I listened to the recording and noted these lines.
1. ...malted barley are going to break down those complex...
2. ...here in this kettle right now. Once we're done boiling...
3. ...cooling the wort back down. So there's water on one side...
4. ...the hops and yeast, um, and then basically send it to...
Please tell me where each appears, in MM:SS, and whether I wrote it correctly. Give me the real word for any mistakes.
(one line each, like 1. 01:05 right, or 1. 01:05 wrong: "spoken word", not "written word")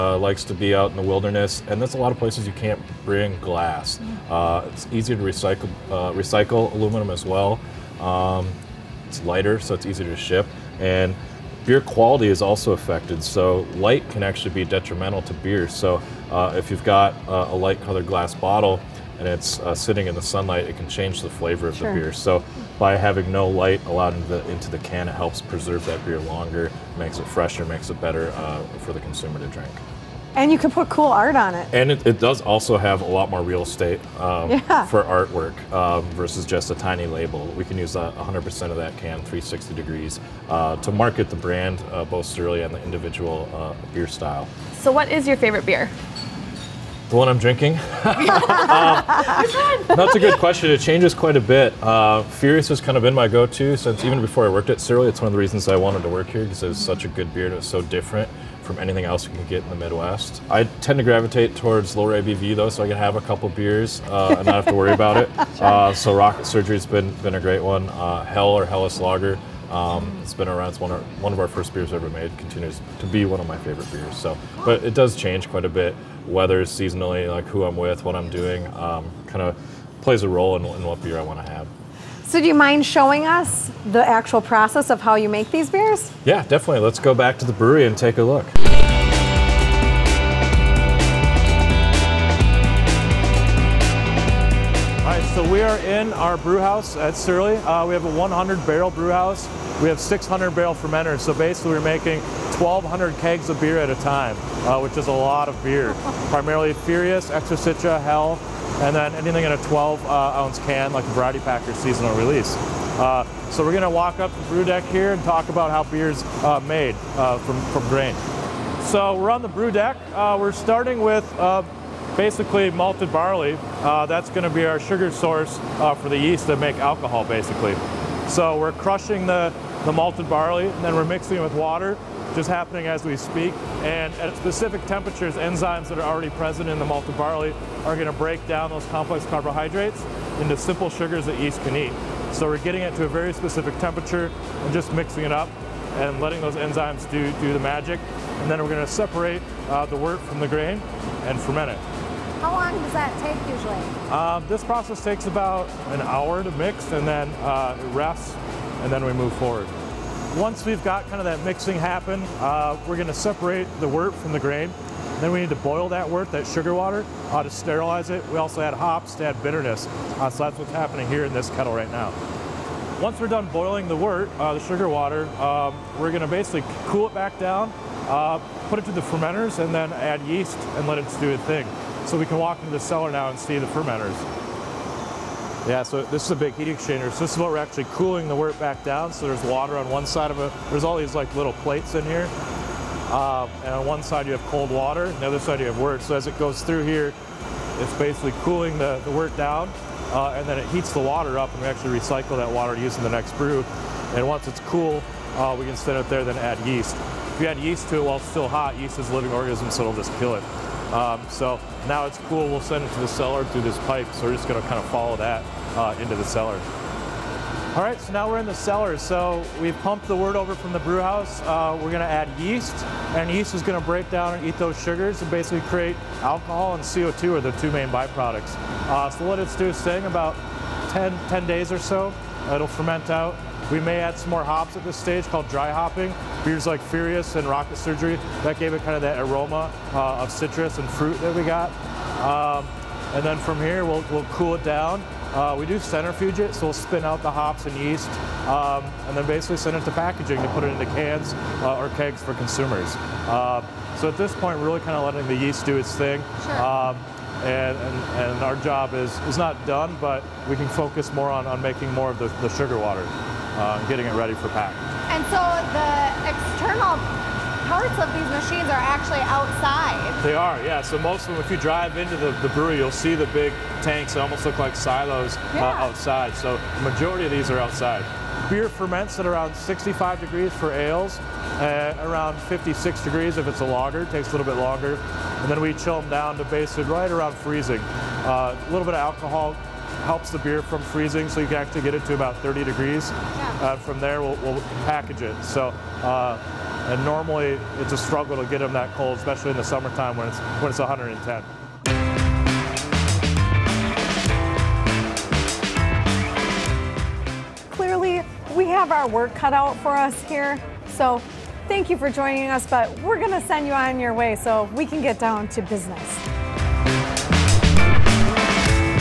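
1. 02:16 right
2. 02:51 right
3. 03:07 right
4. 04:07 right.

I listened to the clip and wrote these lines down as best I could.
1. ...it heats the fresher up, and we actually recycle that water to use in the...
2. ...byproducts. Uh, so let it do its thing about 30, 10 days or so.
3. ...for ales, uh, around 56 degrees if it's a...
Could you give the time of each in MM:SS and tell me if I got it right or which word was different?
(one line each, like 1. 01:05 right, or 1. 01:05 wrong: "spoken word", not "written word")
1. 03:20 wrong: "water", not "fresher"
2. 03:47 wrong: "10", not "30"
3. 04:40 right.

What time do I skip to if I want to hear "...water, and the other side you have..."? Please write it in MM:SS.
03:14.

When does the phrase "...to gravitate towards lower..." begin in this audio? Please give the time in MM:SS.
01:00.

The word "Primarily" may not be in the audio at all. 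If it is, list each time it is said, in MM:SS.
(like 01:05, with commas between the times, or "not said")
01:46.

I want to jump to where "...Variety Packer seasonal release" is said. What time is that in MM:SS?
01:51.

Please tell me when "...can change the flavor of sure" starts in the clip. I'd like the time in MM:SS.
00:20.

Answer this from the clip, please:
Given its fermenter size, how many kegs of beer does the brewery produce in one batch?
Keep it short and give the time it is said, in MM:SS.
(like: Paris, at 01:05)
1,200, at 01:42.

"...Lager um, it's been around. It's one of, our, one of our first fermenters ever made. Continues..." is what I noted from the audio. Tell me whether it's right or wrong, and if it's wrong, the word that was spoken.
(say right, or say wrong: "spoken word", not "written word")
wrong: "beers", not "fermenters".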